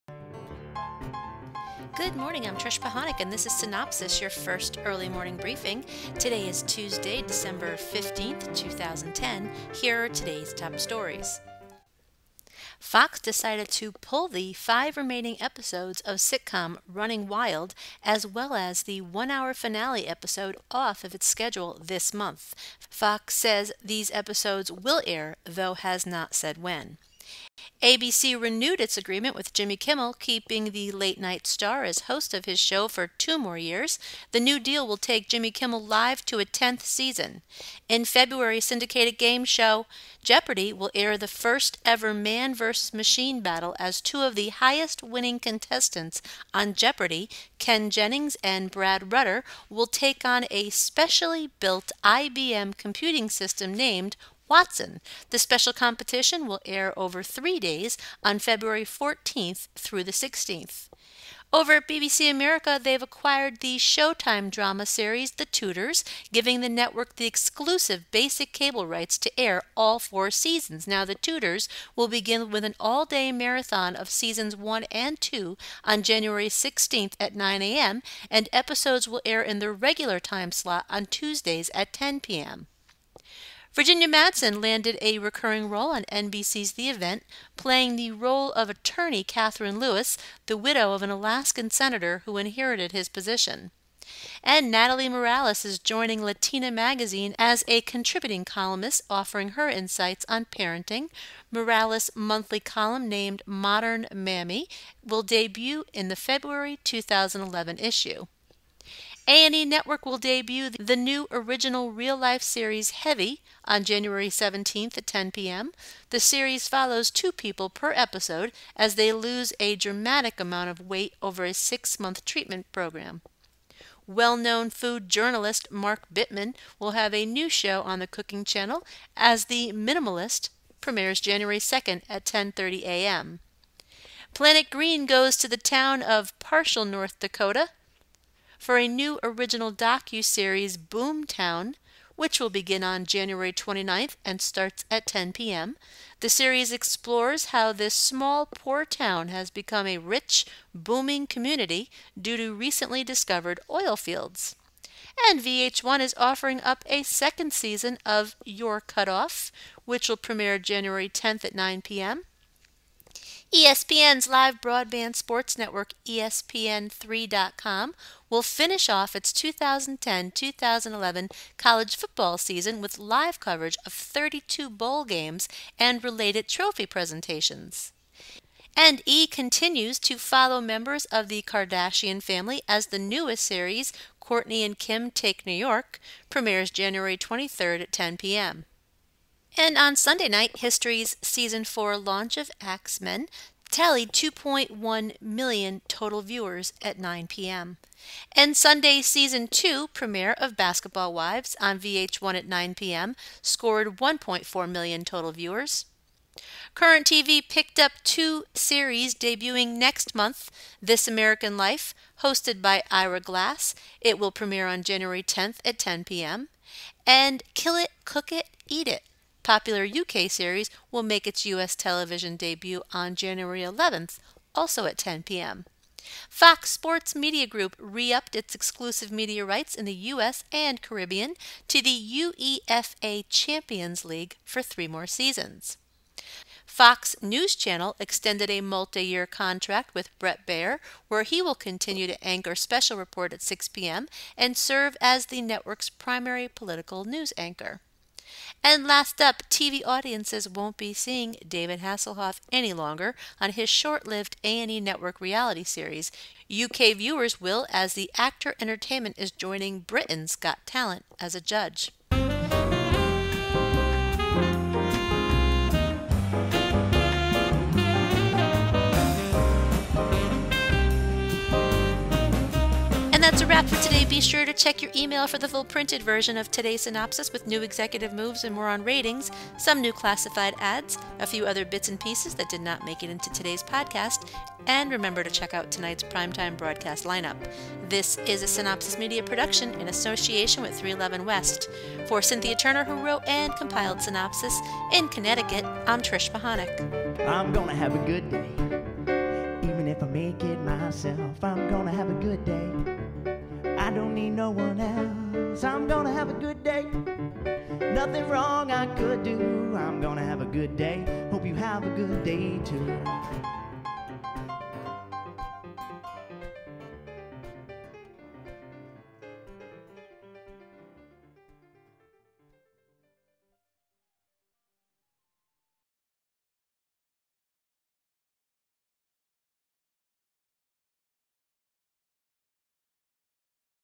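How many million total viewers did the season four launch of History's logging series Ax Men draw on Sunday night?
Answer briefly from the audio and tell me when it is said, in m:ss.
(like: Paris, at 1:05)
2.1 million, at 3:14.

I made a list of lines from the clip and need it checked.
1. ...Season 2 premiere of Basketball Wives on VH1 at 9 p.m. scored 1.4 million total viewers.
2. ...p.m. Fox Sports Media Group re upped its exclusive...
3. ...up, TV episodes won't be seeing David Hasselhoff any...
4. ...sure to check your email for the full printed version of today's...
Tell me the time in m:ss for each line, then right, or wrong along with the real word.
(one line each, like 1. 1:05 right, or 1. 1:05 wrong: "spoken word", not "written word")
1. 3:19 right
2. 3:45 right
3. 4:09 wrong: "audiences", not "episodes"
4. 4:34 right.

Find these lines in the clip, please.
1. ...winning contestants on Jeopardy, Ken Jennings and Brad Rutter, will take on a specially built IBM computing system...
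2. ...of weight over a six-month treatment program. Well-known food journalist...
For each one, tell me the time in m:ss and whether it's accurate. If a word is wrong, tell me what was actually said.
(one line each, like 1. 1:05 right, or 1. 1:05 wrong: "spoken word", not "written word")
1. 0:45 right
2. 2:00 right.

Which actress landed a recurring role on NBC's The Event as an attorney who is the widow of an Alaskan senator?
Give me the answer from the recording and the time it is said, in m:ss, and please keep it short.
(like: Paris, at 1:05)
Virginia Madsen, at 1:23.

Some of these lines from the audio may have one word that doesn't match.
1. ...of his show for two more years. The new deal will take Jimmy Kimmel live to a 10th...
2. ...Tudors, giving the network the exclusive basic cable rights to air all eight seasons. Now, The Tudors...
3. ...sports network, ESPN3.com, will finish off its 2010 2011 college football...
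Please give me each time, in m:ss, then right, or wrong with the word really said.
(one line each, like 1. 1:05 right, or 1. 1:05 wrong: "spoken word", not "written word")
1. 0:32 right
2. 1:05 wrong: "four", not "eight"
3. 2:45 right.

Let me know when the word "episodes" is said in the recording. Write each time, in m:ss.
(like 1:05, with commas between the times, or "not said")
0:15, 0:20, 0:24, 1:18, 1:57.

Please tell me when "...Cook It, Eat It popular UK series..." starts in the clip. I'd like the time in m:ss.
3:38.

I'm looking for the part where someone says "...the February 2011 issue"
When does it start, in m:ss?
1:46.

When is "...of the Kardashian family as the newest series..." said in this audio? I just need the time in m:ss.
3:01.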